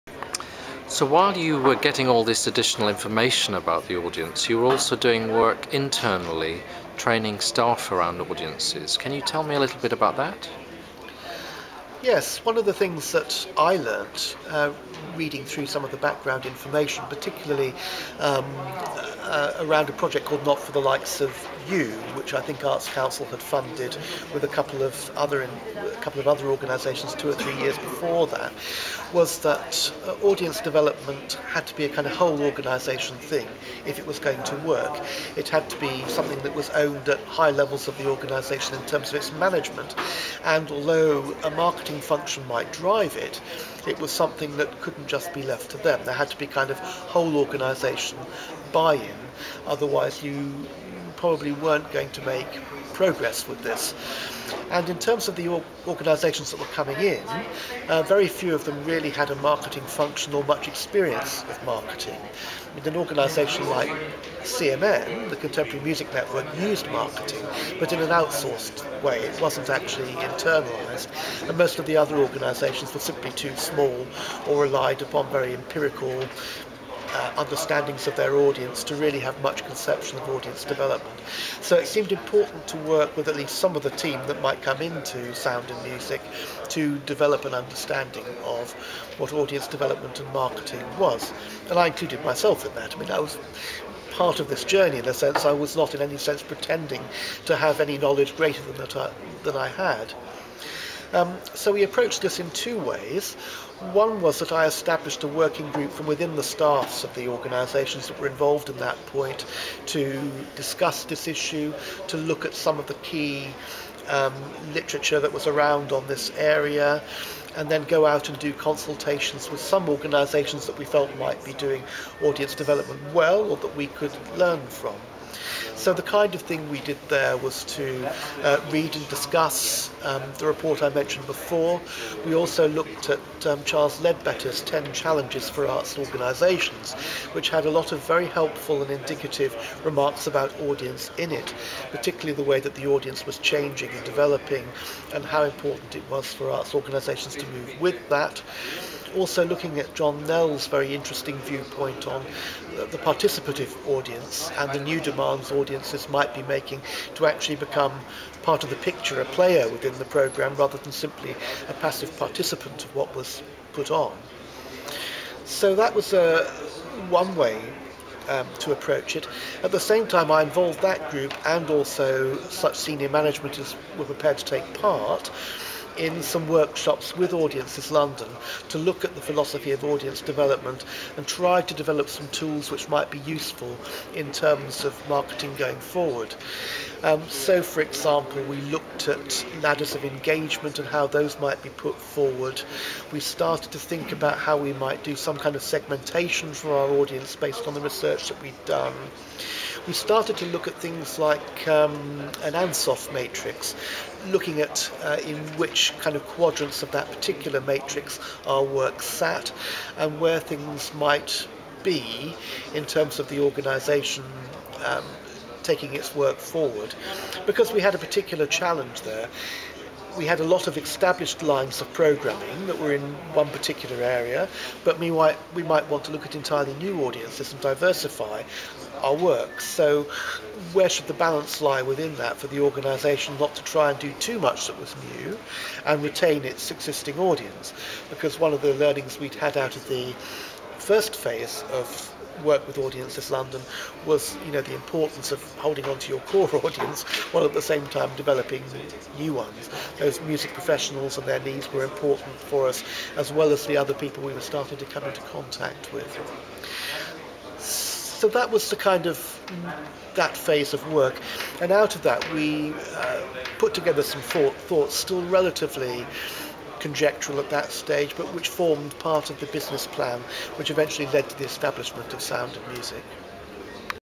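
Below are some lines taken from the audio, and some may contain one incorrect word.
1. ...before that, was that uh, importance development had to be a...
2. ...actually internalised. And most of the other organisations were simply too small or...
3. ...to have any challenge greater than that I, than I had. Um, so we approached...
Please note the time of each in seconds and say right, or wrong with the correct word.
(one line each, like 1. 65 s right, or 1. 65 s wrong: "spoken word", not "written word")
1. 27 s wrong: "audience", not "importance"
2. 69 s right
3. 97 s wrong: "knowledge", not "challenge".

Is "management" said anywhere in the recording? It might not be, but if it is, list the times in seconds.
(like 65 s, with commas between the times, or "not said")
39 s, 173 s.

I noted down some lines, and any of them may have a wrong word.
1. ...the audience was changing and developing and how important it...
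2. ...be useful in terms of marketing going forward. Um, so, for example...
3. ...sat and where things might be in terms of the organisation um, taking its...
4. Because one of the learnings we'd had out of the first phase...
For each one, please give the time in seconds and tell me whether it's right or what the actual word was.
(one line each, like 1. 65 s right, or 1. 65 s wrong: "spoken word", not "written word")
1. 142 s right
2. 183 s right
3. 209 s right
4. 238 s right.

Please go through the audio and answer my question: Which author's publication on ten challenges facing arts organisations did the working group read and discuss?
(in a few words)
Charles Leadbeater.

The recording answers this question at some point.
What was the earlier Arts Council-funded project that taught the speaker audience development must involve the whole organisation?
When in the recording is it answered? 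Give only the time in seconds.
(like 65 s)
20 s.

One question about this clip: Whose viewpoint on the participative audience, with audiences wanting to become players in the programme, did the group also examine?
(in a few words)
John Knell.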